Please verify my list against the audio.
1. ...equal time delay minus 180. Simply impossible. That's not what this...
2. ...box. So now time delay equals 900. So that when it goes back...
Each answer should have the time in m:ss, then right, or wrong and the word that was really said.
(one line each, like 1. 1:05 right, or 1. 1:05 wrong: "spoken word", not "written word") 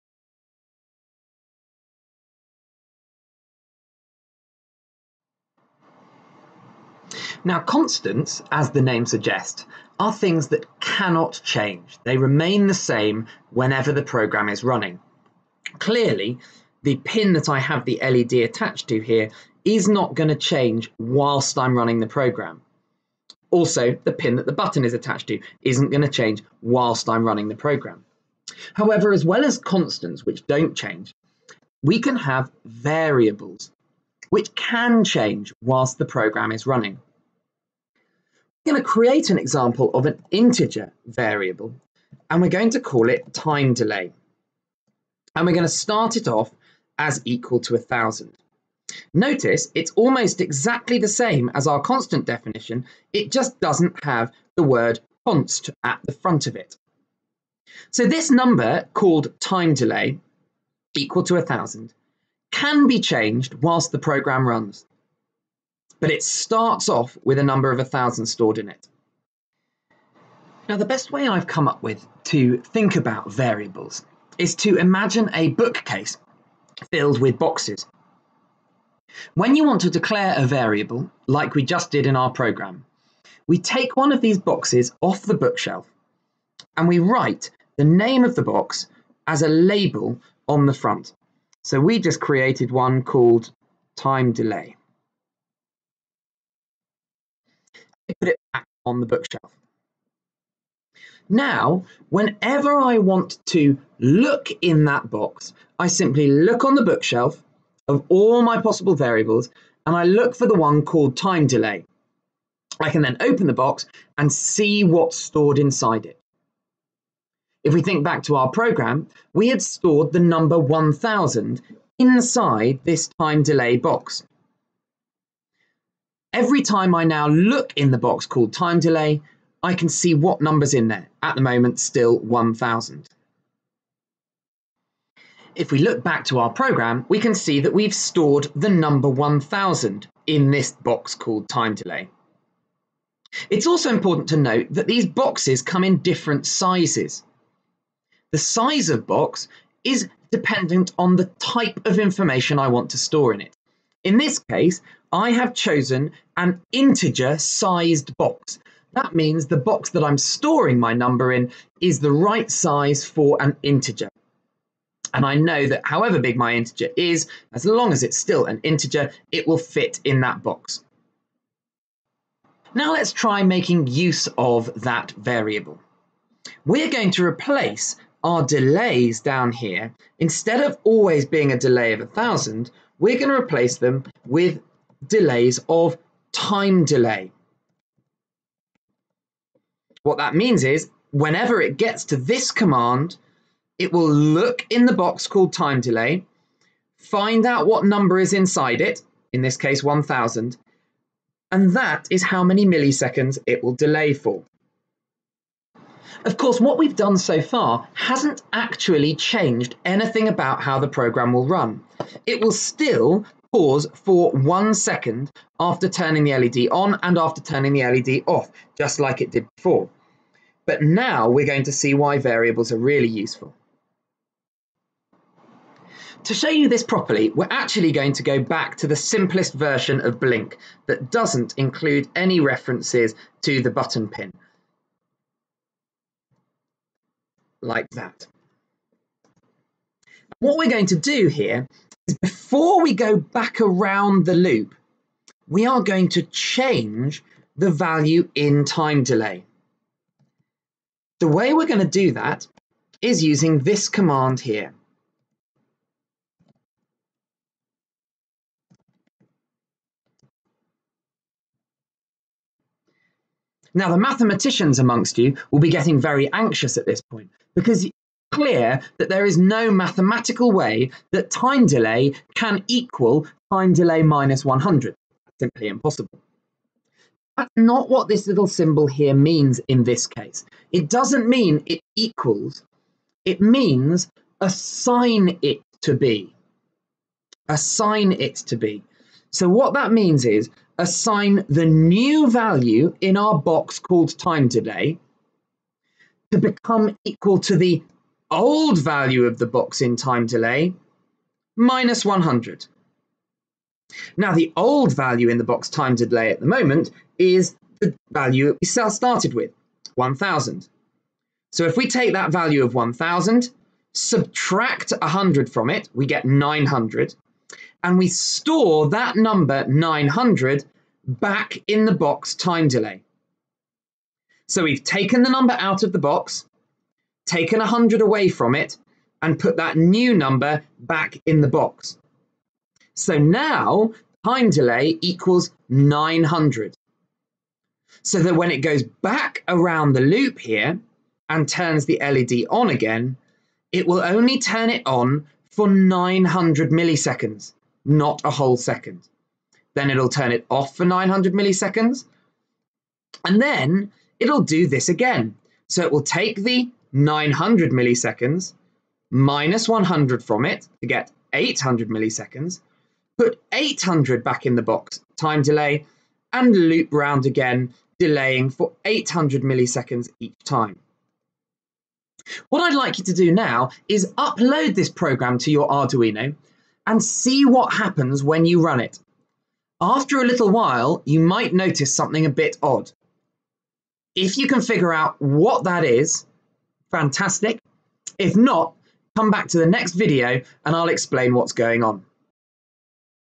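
1. 4:32 wrong: "100", not "180"
2. 5:31 right.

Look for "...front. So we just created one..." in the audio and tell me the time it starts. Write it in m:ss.
1:30.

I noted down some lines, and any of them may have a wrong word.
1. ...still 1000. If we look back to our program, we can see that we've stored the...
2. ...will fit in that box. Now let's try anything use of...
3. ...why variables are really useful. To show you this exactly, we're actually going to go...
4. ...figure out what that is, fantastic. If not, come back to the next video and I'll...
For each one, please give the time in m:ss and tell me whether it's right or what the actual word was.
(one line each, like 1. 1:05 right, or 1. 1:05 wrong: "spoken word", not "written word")
1. 2:11 right
2. 2:49 wrong: "making", not "anything"
3. 3:41 wrong: "properly", not "exactly"
4. 6:24 right.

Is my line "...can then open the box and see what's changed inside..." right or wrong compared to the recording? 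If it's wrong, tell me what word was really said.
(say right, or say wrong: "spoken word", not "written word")
wrong: "stored", not "changed".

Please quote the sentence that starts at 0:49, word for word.
Notice it's almost exactly the same as our constant definition, it just doesn't have the word const at the front of it.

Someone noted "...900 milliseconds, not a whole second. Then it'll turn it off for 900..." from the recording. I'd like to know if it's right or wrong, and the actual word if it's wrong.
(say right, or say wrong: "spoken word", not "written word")
right.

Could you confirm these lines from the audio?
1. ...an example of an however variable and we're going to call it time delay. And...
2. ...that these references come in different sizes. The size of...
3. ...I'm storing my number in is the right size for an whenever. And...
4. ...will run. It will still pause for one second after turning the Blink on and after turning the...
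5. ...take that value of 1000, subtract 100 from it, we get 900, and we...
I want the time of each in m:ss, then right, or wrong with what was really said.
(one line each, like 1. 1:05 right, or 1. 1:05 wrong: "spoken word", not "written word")
1. 0:39 wrong: "integer", not "however"
2. 2:24 wrong: "boxes", not "references"
3. 2:40 wrong: "integer", not "whenever"
4. 3:31 wrong: "LED", not "Blink"
5. 5:11 right.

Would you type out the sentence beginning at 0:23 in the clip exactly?
Also, the pin that the button is attached to isn't going to change whilst I'm running the program.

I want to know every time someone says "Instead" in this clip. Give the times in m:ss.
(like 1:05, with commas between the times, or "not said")
3:00.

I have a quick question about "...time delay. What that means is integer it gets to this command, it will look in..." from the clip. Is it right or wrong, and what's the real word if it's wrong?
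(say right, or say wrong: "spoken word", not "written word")
wrong: "whenever", not "integer".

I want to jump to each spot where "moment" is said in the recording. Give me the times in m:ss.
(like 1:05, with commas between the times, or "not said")
2:11, 5:06.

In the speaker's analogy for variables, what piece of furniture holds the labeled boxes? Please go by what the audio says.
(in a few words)
bookcase.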